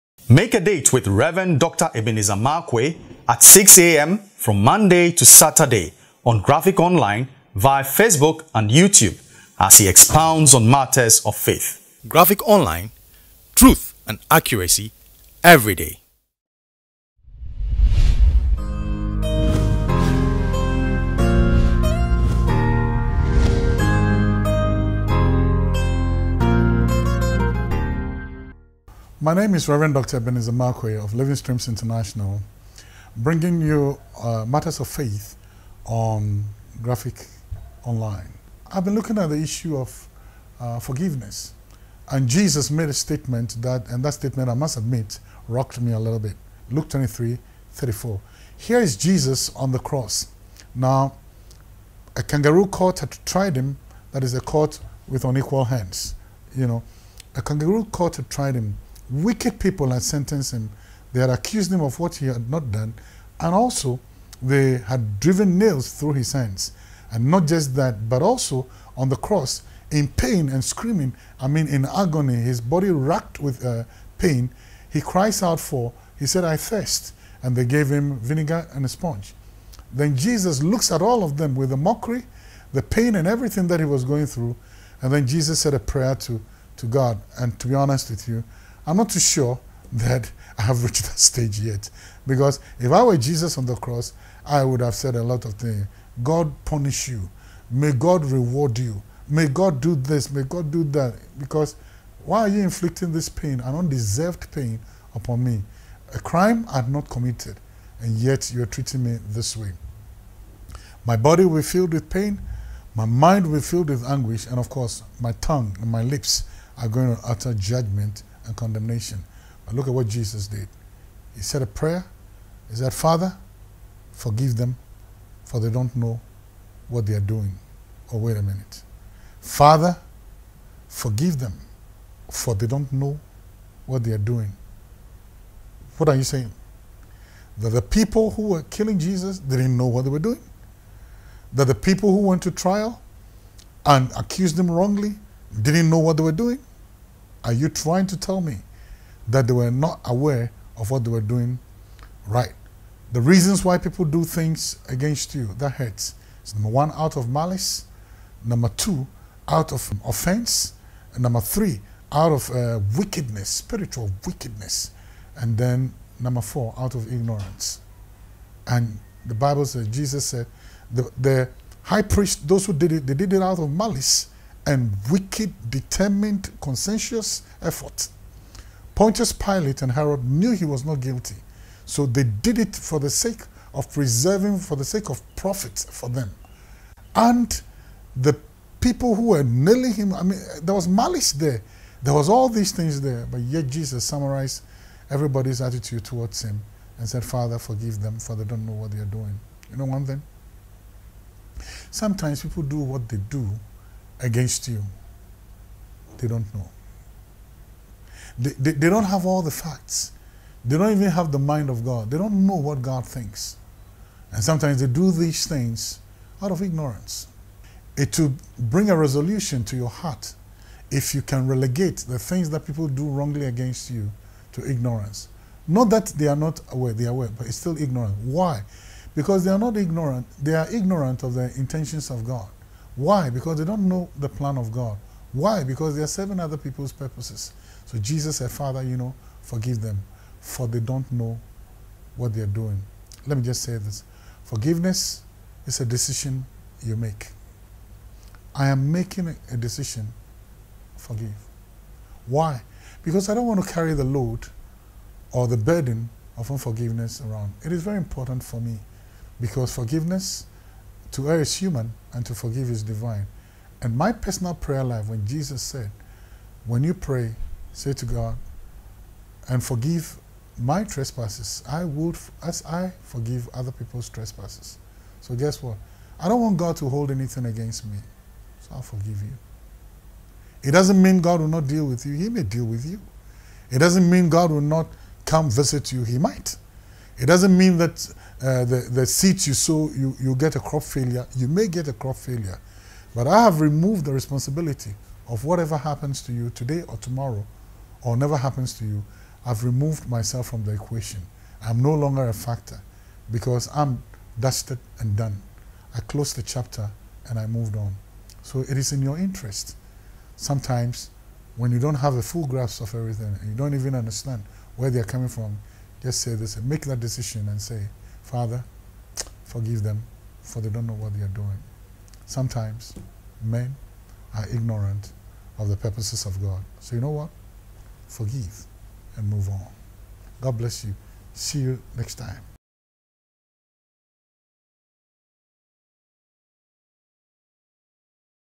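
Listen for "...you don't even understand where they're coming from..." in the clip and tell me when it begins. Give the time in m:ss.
5:13.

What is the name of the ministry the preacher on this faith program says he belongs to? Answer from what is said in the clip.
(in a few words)
Living Streams International.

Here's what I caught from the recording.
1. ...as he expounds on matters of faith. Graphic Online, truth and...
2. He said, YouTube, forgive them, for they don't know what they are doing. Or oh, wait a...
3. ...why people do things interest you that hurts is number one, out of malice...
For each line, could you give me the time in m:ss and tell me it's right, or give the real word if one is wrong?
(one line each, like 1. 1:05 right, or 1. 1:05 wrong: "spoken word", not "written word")
1. 0:09 right
2. 2:02 wrong: "Father", not "YouTube"
3. 2:33 wrong: "against", not "interest".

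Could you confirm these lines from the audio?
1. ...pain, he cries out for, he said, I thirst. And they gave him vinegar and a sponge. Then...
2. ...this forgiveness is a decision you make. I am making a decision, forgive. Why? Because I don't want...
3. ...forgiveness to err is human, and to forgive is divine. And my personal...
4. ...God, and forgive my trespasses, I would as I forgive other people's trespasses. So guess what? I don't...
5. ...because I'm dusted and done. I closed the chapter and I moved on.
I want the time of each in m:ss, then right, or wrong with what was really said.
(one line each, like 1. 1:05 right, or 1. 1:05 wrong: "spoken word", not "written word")
1. 1:14 right
2. 4:03 right
3. 4:19 right
4. 4:28 right
5. 5:03 right.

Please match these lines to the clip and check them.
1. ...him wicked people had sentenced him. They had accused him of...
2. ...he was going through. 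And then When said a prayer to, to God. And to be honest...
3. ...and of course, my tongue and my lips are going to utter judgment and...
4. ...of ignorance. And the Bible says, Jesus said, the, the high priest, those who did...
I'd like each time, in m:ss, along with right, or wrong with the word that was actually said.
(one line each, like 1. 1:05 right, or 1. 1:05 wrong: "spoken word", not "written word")
1. 0:58 right
2. 1:23 wrong: "Jesus", not "When"
3. 1:54 right
4. 2:46 right.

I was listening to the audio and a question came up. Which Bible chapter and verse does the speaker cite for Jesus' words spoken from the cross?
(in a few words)
Luke 23:34.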